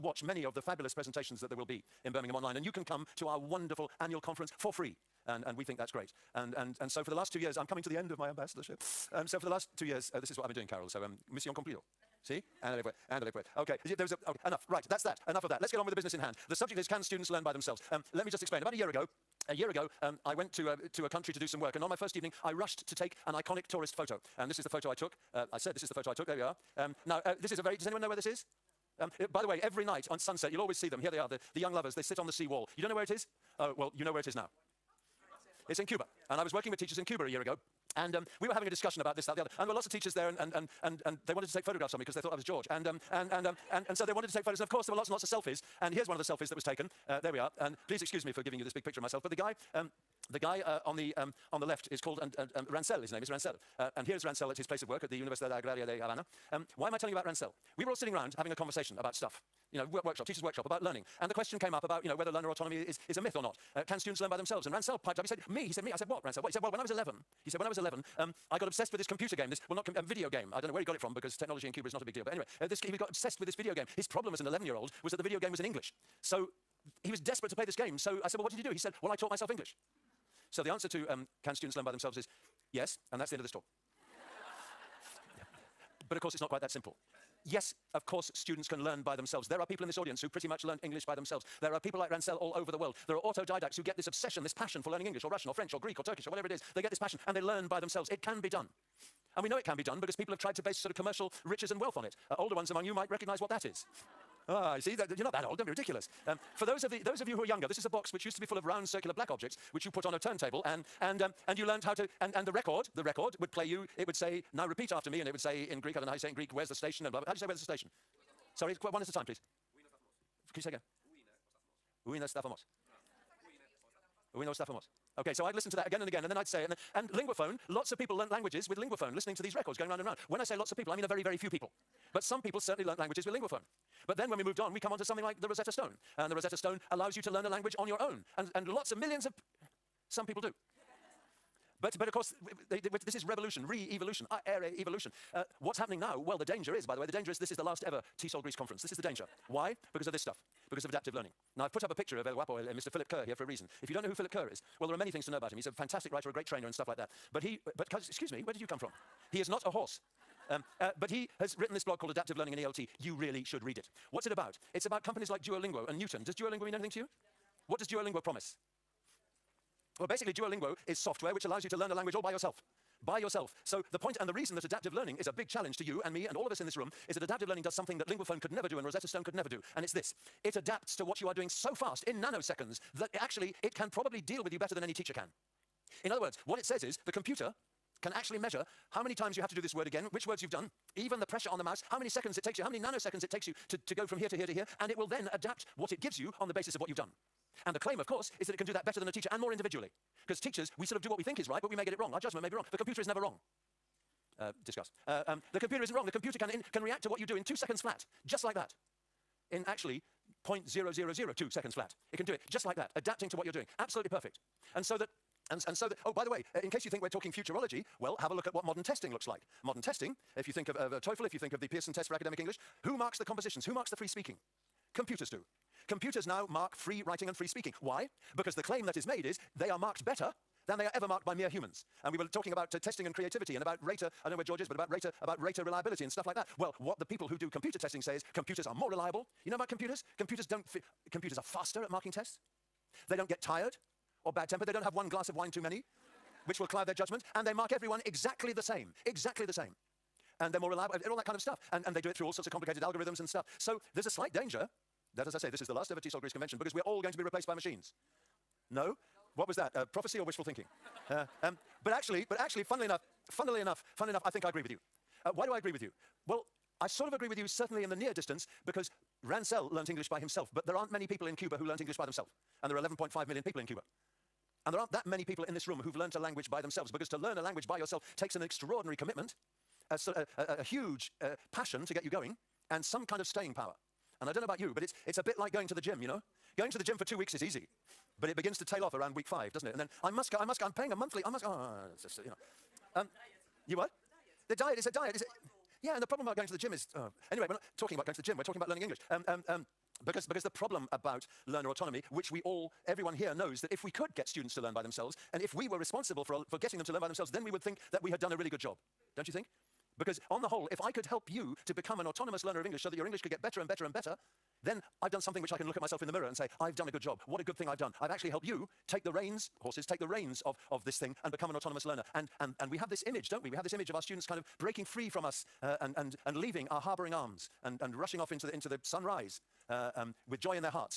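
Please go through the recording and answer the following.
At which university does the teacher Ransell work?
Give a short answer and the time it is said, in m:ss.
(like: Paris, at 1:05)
Universidad Agraria de Havana, at 0:55.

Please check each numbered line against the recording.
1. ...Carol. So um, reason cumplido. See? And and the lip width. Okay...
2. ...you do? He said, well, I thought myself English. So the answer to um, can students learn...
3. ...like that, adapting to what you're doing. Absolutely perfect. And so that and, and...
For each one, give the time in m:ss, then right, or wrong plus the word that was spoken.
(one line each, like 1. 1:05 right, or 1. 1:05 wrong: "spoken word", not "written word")
1. 0:10 wrong: "mission", not "reason"
2. 1:18 wrong: "taught", not "thought"
3. 3:32 right.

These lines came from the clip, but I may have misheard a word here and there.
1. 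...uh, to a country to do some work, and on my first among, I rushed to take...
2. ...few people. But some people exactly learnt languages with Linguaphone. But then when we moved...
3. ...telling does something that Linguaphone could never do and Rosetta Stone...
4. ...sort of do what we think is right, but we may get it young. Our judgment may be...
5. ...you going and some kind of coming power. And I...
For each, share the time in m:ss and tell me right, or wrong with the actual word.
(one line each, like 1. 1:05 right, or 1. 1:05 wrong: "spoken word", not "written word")
1. 0:20 wrong: "evening", not "among"
2. 2:11 wrong: "certainly", not "exactly"
3. 2:57 wrong: "learning", not "telling"
4. 3:20 wrong: "wrong", not "young"
5. 4:42 wrong: "staying", not "coming".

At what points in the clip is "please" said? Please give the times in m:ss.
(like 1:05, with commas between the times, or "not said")
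0:47, 1:59.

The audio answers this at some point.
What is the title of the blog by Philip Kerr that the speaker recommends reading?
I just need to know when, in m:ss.
2:42.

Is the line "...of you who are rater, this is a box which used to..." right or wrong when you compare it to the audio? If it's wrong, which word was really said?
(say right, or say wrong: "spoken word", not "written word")
wrong: "younger", not "rater".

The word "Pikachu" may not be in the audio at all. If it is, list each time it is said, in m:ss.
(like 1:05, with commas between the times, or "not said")
not said.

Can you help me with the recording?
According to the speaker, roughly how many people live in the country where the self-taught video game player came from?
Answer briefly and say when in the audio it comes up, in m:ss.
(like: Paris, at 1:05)
11.5 million, at 4:32.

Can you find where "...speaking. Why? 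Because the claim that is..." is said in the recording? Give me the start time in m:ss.
3:47.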